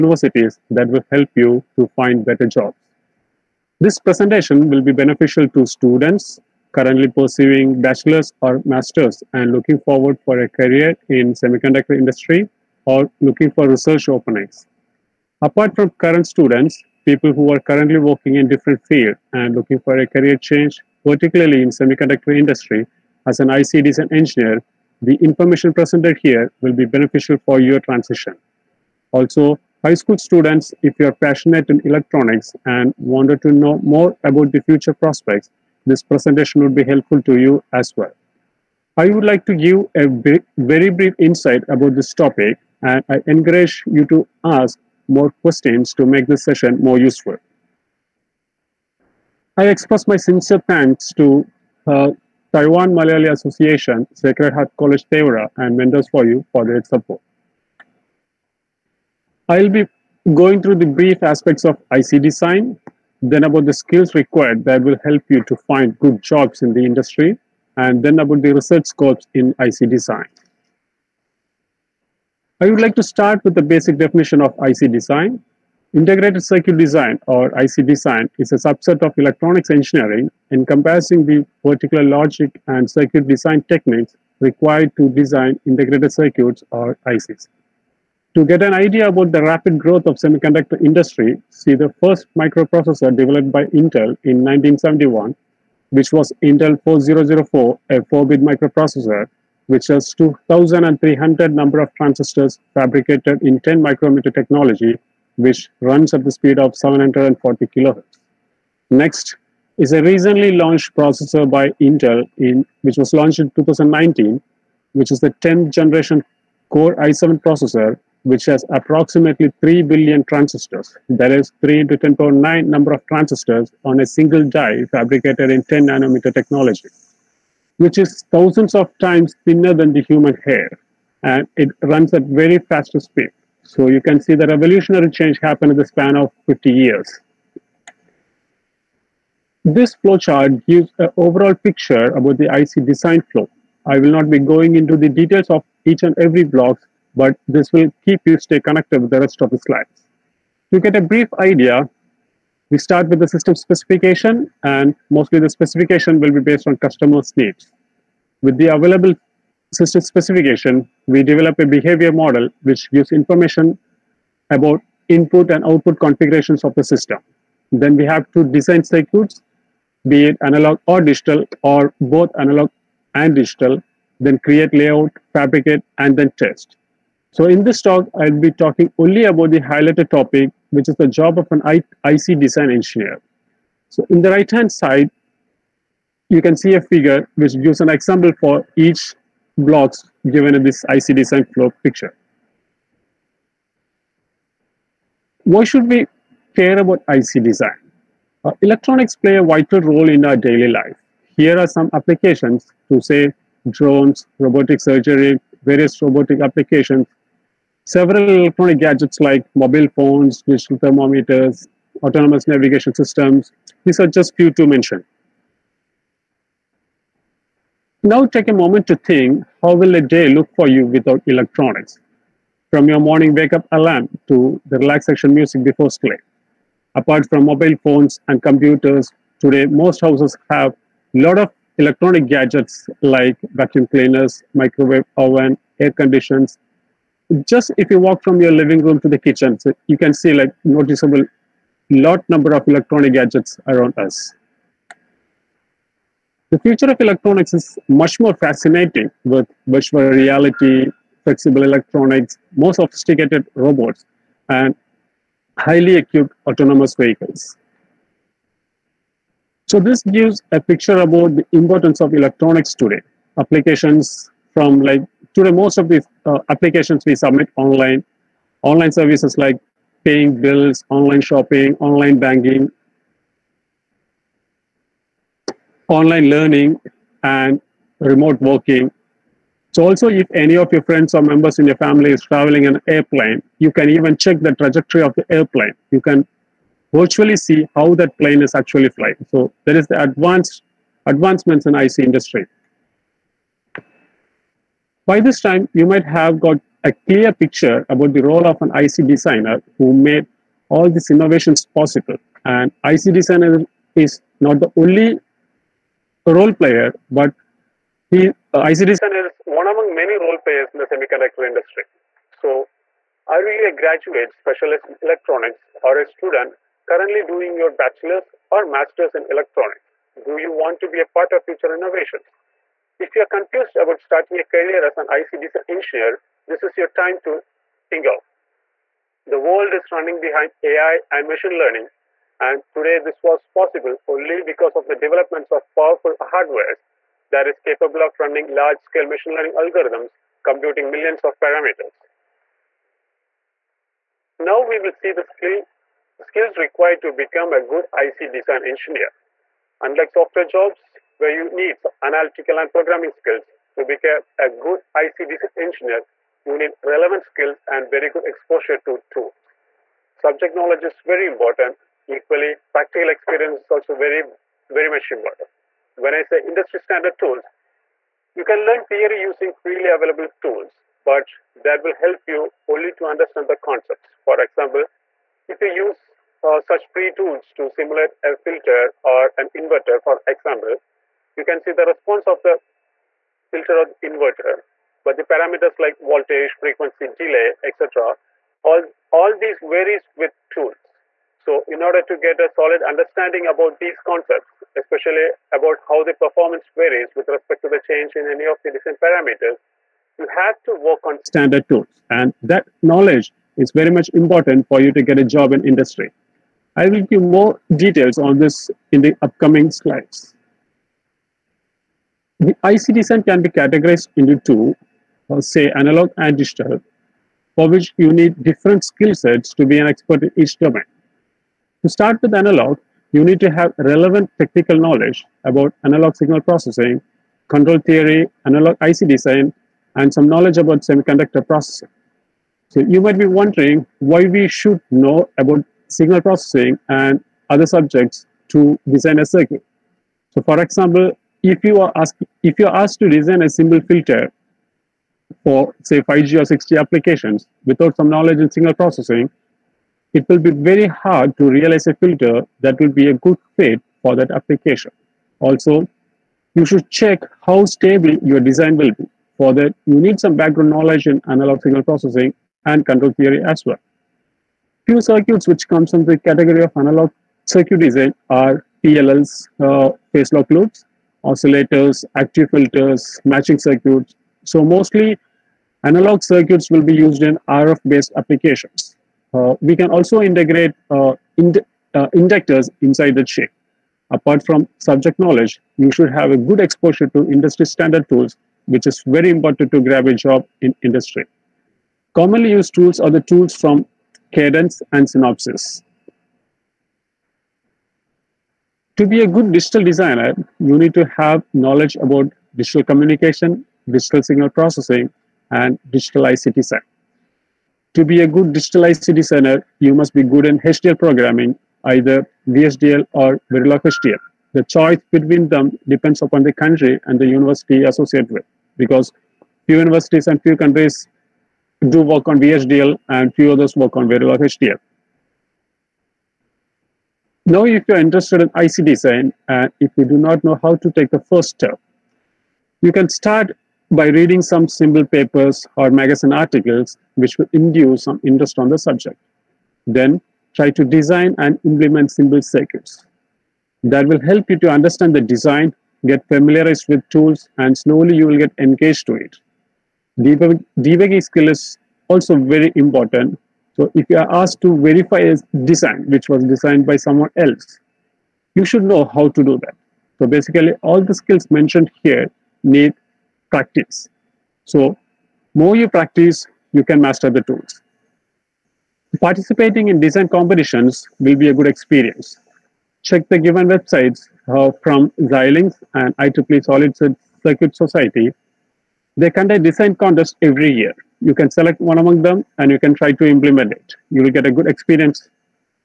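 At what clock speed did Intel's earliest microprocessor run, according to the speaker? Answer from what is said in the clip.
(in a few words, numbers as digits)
740 kilohertz.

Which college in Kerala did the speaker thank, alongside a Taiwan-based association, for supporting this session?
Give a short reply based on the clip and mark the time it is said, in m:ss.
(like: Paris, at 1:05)
Sacred Heart College Thevara, at 0:54.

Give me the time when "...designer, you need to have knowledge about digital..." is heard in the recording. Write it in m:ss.
8:19.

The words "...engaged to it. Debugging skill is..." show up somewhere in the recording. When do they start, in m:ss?
9:08.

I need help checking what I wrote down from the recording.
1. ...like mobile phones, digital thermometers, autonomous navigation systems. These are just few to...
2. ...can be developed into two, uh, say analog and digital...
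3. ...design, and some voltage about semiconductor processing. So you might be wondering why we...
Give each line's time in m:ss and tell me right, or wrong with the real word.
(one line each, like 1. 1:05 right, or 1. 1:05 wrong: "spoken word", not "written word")
1. 3:29 right
2. 6:53 wrong: "categorized", not "developed"
3. 7:09 wrong: "knowledge", not "voltage".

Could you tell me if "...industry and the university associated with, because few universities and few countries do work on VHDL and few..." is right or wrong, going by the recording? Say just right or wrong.
wrong.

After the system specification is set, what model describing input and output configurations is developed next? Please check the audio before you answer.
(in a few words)
behavior model.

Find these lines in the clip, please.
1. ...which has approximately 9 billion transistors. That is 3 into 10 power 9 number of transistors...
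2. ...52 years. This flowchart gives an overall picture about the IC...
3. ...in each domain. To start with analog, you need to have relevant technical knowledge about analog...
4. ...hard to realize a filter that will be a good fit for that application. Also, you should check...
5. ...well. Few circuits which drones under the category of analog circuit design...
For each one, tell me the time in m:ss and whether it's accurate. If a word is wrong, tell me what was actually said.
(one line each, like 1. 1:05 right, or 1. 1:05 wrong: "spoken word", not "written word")
1. 1:58 wrong: "3", not "9"
2. 2:16 wrong: "50", not "52"
3. 7:00 right
4. 7:30 right
5. 7:43 wrong: "comes", not "drones".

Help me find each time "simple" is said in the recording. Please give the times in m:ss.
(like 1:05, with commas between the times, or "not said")
7:23, 8:54, 9:02.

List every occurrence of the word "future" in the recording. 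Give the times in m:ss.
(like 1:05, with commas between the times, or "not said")
0:34, 4:06, 5:21.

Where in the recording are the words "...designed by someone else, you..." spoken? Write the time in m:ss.
9:16.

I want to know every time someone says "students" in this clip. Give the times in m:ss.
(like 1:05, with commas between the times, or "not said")
0:05, 0:16, 0:30, 5:16.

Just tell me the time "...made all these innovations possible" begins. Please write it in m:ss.
4:59.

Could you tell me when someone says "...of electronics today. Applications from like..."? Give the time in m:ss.
4:22.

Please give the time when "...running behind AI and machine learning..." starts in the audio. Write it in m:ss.
5:29.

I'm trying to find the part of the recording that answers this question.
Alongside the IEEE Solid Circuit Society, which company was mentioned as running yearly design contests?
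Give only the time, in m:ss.
9:35.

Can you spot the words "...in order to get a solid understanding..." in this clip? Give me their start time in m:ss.
6:31.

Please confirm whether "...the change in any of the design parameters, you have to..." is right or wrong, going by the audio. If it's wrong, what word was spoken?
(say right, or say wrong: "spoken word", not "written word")
right.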